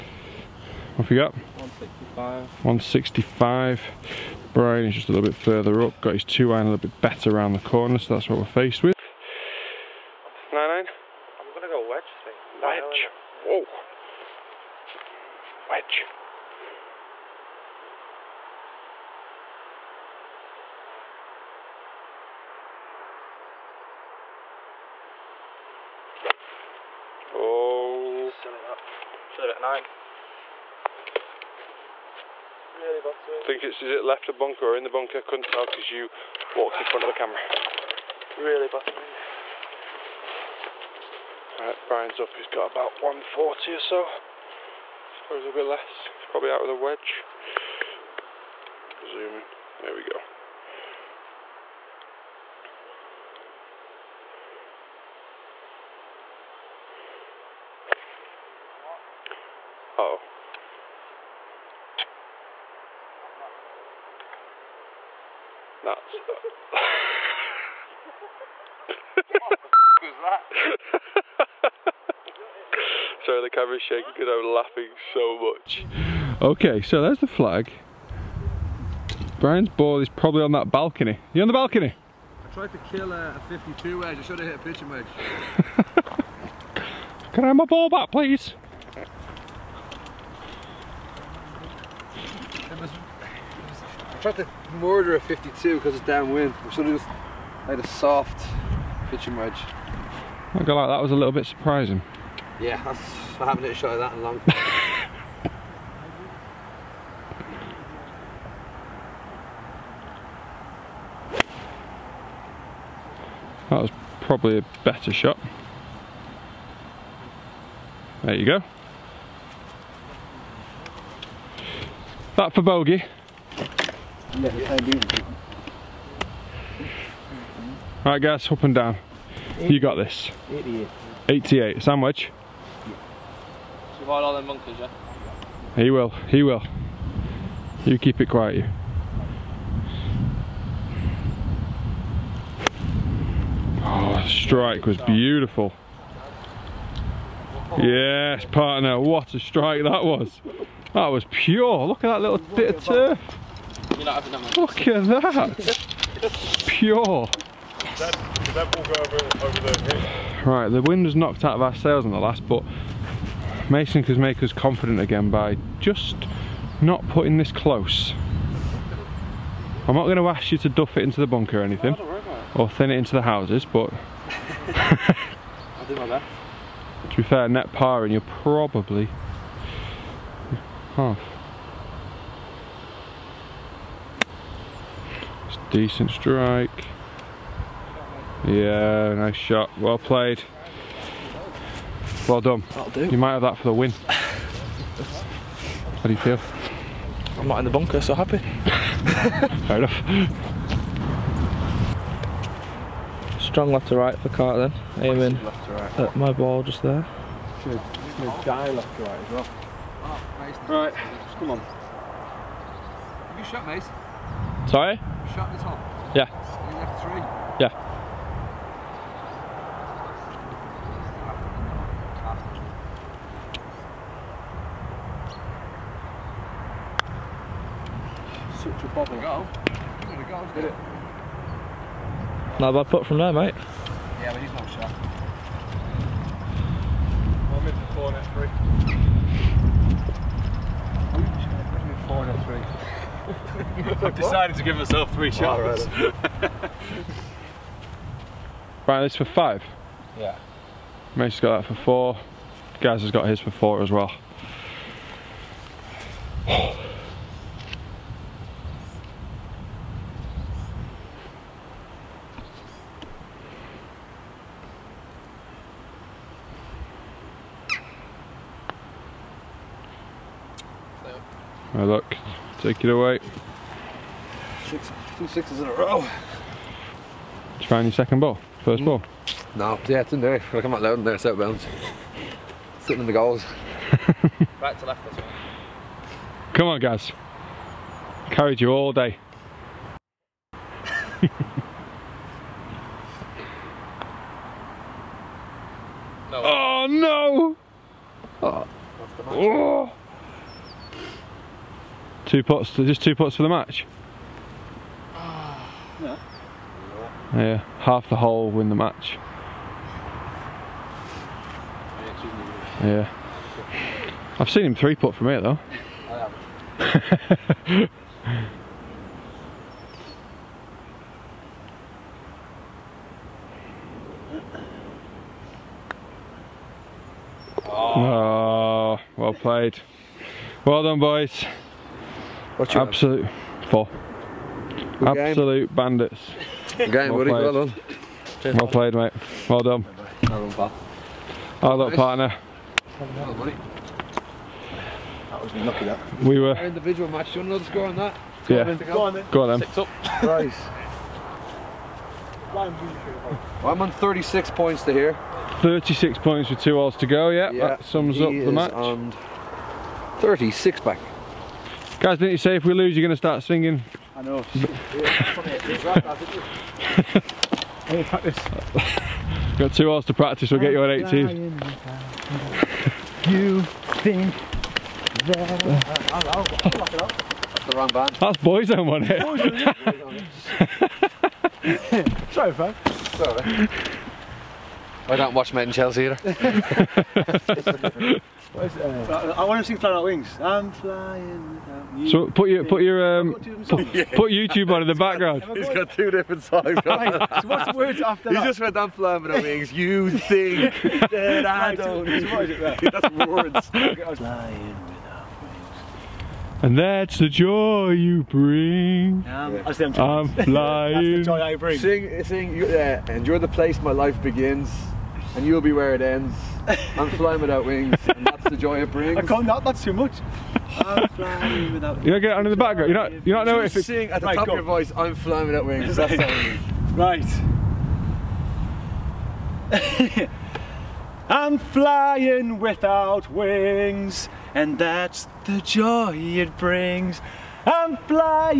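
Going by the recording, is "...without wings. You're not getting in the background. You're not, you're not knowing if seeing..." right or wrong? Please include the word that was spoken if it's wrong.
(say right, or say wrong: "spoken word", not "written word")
right.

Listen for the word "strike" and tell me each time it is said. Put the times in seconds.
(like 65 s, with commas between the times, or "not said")
144 s, 149 s, 186 s.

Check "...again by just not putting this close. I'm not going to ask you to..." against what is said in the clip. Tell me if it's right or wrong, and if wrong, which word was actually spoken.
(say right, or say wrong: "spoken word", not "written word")
right.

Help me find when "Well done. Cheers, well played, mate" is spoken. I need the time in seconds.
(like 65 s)
337 s.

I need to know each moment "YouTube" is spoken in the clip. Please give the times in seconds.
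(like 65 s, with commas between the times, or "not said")
394 s.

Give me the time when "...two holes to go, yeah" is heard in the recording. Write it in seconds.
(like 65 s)
356 s.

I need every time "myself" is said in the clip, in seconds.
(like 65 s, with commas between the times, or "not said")
244 s.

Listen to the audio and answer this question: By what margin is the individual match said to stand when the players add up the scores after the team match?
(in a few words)
6 up.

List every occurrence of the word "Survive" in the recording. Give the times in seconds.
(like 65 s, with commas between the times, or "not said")
133 s.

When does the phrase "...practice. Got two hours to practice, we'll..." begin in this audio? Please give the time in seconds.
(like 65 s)
368 s.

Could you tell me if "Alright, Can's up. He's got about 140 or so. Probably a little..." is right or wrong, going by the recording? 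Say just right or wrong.
wrong.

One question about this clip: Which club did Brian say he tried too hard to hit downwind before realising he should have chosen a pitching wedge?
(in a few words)
52 wedge.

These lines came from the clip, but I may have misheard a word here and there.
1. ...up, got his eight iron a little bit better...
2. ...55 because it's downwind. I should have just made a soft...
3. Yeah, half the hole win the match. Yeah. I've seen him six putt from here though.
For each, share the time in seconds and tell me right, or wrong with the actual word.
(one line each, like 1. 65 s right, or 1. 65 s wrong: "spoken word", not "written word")
1. 5 s wrong: "two", not "eight"
2. 95 s wrong: "52", not "55"
3. 307 s wrong: "three", not "six".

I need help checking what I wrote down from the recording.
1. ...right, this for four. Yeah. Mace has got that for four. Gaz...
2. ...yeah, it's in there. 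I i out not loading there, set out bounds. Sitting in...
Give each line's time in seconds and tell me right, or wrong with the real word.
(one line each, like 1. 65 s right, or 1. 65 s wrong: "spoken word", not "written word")
1. 248 s wrong: "five", not "four"
2. 279 s right.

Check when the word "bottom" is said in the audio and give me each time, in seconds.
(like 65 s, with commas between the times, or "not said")
33 s, 38 s.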